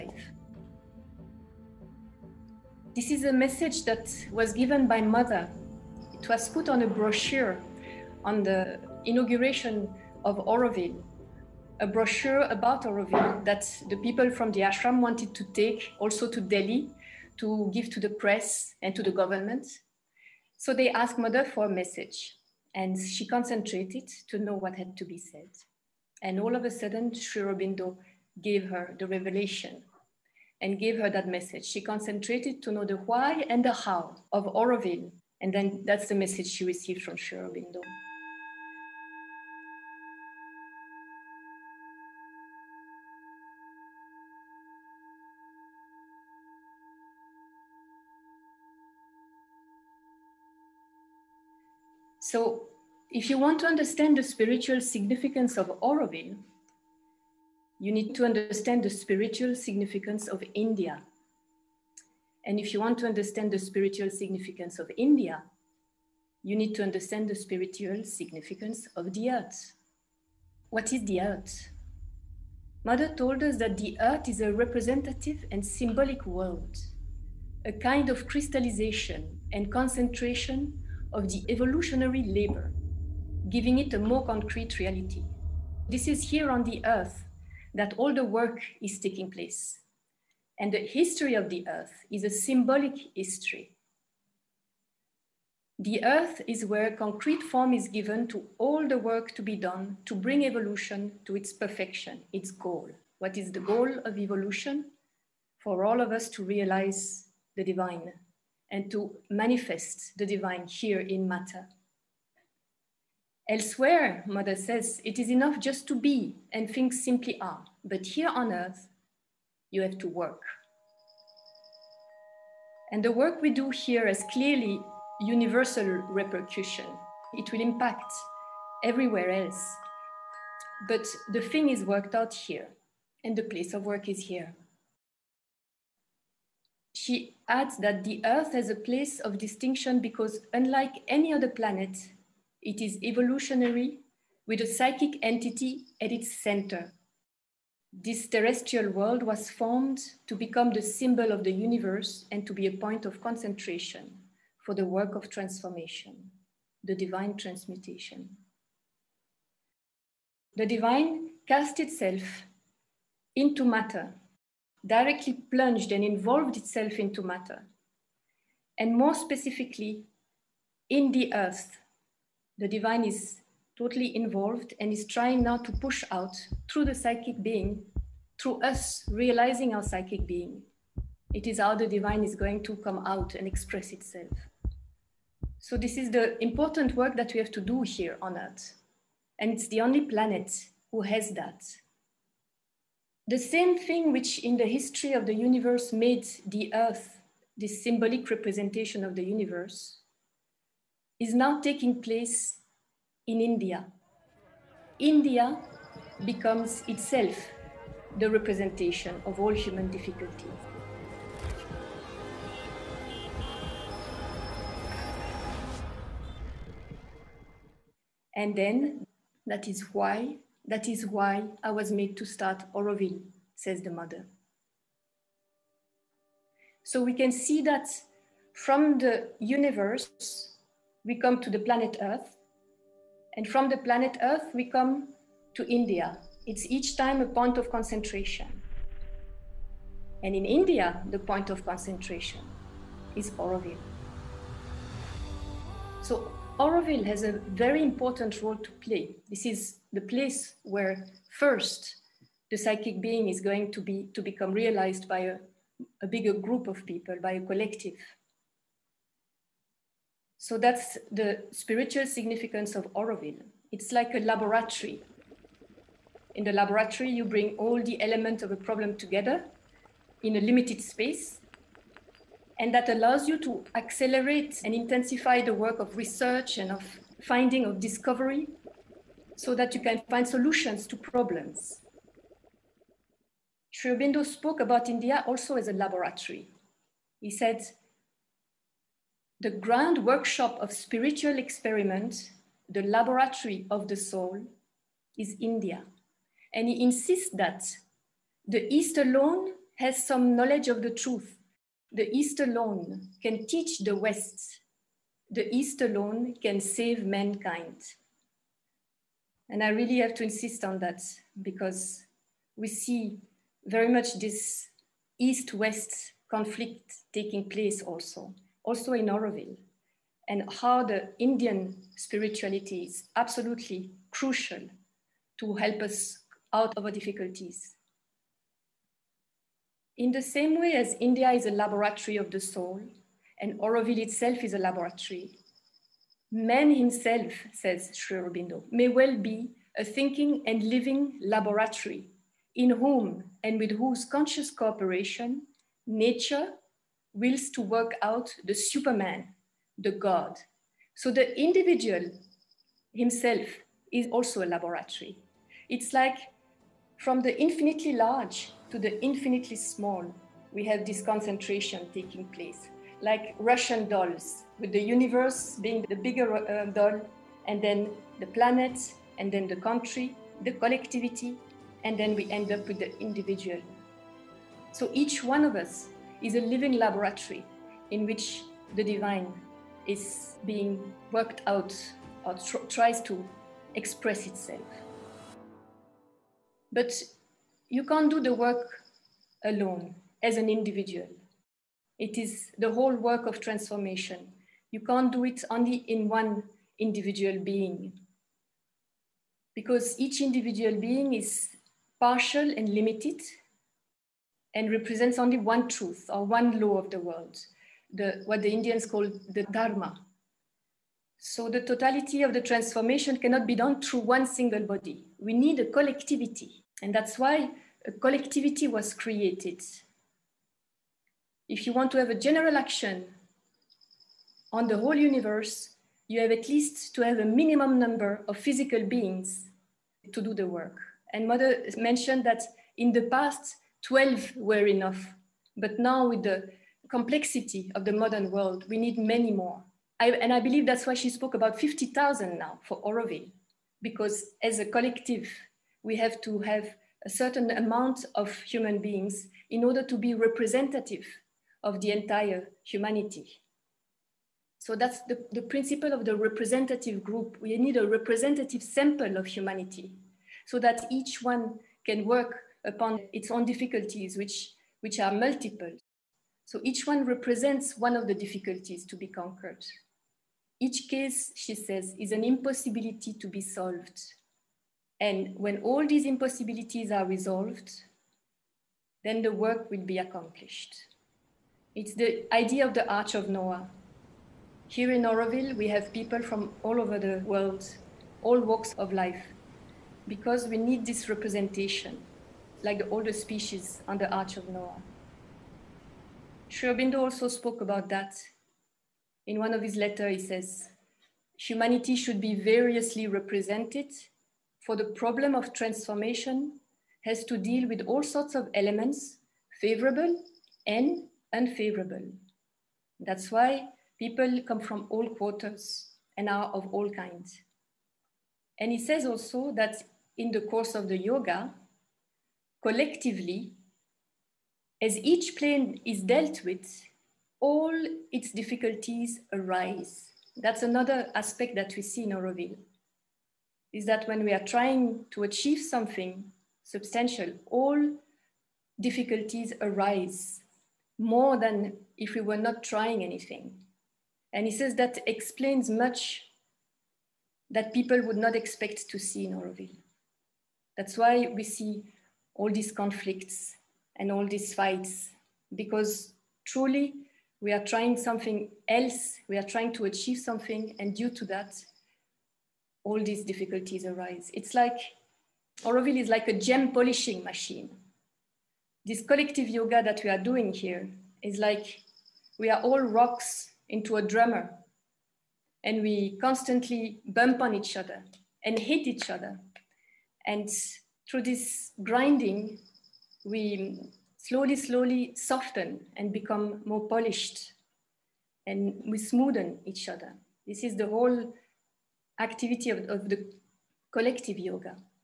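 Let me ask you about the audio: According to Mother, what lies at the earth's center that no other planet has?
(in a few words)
a psychic entity.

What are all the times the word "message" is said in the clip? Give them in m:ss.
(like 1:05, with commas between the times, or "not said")
0:03, 0:21, 0:31, 0:36.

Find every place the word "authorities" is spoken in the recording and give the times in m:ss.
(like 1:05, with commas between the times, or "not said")
not said.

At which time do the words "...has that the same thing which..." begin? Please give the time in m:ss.
3:11.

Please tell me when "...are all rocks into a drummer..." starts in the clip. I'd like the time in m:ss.
9:32.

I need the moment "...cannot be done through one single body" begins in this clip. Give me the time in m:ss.
6:53.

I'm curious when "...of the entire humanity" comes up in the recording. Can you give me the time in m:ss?
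7:31.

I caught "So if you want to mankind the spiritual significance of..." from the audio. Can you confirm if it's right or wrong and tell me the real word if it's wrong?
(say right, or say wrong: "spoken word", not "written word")
wrong: "understand", not "mankind".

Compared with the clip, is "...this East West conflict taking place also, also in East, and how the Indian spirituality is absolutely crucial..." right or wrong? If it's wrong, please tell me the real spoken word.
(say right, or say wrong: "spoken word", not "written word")
wrong: "Auroville", not "East".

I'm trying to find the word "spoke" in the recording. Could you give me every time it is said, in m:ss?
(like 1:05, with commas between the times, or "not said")
4:44, 7:21, 8:17.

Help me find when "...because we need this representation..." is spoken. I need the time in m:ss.
8:10.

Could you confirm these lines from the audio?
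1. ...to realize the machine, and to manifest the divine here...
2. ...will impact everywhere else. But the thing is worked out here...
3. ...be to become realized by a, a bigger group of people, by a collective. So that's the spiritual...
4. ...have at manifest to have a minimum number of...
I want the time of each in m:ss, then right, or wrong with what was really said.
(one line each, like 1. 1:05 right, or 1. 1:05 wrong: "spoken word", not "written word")
1. 1:46 wrong: "divine", not "machine"
2. 2:07 right
3. 4:13 right
4. 7:06 wrong: "least", not "manifest".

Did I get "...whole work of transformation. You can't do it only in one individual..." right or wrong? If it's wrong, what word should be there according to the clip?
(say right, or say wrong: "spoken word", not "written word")
right.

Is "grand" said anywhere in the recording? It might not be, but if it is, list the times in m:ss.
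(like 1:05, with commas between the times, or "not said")
4:49.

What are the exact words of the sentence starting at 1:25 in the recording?
This is here on the earth that all the work is taking place.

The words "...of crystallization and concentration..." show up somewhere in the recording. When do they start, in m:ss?
1:18.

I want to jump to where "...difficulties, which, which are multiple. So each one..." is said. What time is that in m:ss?
7:43.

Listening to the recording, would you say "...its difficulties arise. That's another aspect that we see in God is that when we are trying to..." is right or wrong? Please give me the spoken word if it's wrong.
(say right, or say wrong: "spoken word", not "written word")
wrong: "Auroville", not "God".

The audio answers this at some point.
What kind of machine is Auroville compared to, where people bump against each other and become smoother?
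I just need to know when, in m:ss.
9:26.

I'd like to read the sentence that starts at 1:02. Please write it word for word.
And if you want to understand the spiritual significance of India, you need to understand the spiritual significance of the earth.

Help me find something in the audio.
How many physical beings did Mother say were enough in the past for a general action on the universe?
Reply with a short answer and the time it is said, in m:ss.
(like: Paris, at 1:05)
12, at 7:13.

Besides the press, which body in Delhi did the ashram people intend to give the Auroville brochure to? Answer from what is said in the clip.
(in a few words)
the government.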